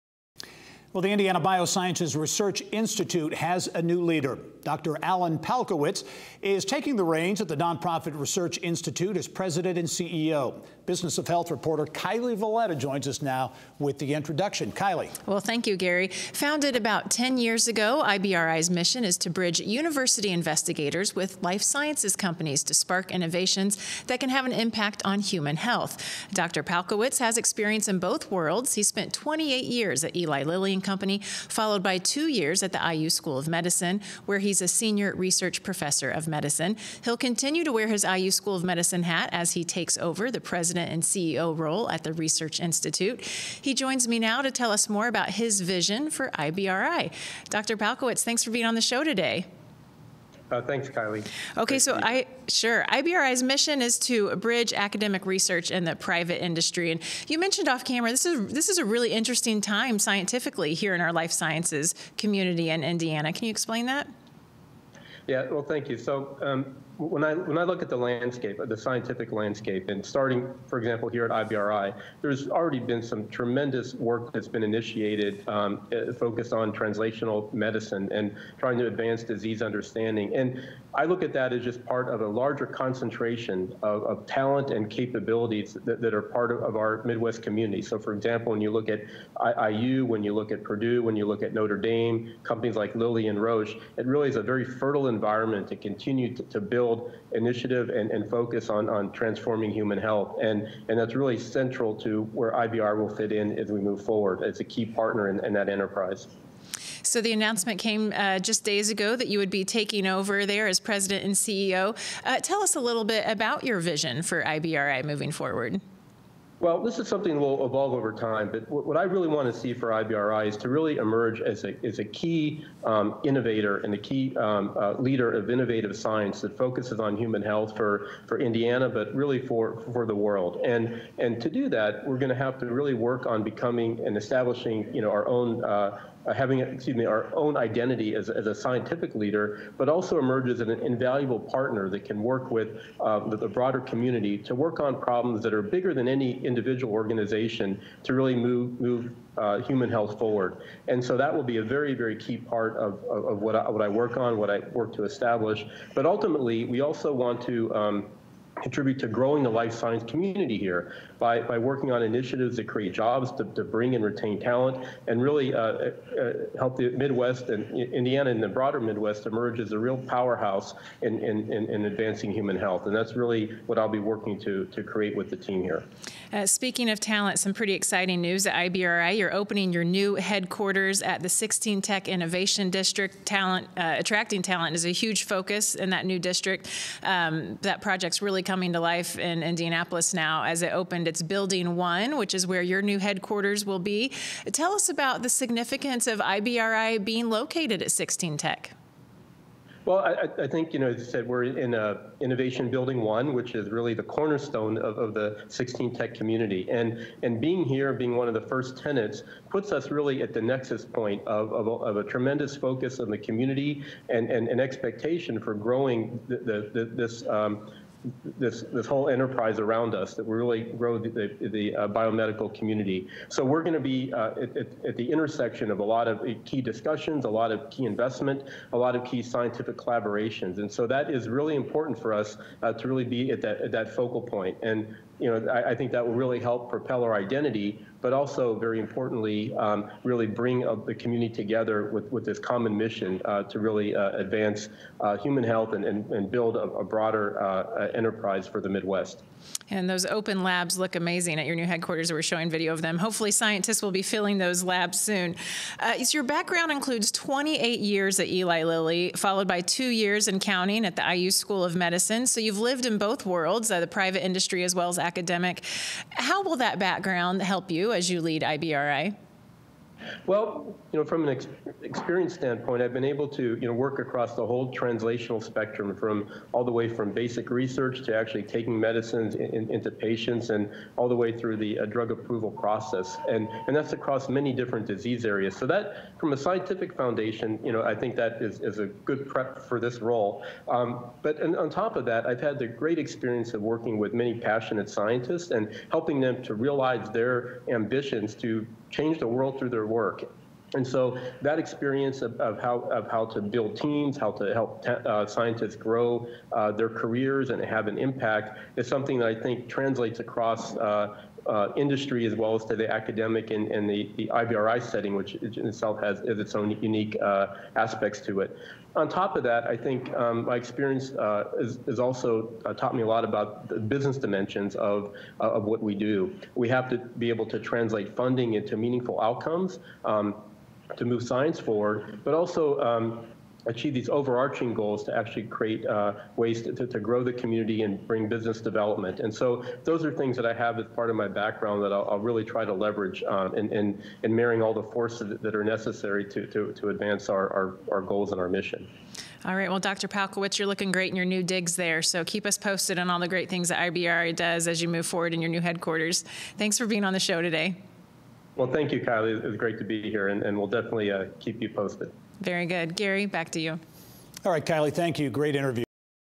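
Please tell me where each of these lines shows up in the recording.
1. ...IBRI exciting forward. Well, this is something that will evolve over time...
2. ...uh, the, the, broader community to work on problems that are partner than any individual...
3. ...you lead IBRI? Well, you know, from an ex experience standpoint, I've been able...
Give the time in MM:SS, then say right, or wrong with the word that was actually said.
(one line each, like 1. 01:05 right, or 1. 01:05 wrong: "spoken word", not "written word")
1. 01:54 wrong: "moving", not "exciting"
2. 02:22 wrong: "bigger", not "partner"
3. 04:28 right.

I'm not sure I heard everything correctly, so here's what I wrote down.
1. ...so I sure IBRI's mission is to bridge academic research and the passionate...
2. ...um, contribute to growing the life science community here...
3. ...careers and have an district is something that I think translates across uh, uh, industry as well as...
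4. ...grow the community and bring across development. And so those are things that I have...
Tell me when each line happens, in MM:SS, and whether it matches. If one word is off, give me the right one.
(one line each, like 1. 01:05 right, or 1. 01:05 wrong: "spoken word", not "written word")
1. 00:51 wrong: "private", not "passionate"
2. 02:37 right
3. 05:06 wrong: "impact", not "district"
4. 05:36 wrong: "business", not "across".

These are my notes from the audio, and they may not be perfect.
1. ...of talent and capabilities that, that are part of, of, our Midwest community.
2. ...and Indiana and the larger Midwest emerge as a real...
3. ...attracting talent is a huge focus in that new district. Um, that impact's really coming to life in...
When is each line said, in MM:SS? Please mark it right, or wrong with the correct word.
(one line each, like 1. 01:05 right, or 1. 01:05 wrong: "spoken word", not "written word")
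1. 01:24 right
2. 02:47 wrong: "broader", not "larger"
3. 03:03 wrong: "project", not "impact".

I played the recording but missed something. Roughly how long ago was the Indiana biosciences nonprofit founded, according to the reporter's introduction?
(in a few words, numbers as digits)
About 10 years ago.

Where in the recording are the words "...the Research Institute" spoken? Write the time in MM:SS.
00:42.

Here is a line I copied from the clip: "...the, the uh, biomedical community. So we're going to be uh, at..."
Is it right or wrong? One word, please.
right.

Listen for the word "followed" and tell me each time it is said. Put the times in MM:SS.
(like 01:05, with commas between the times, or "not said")
00:31, 04:19.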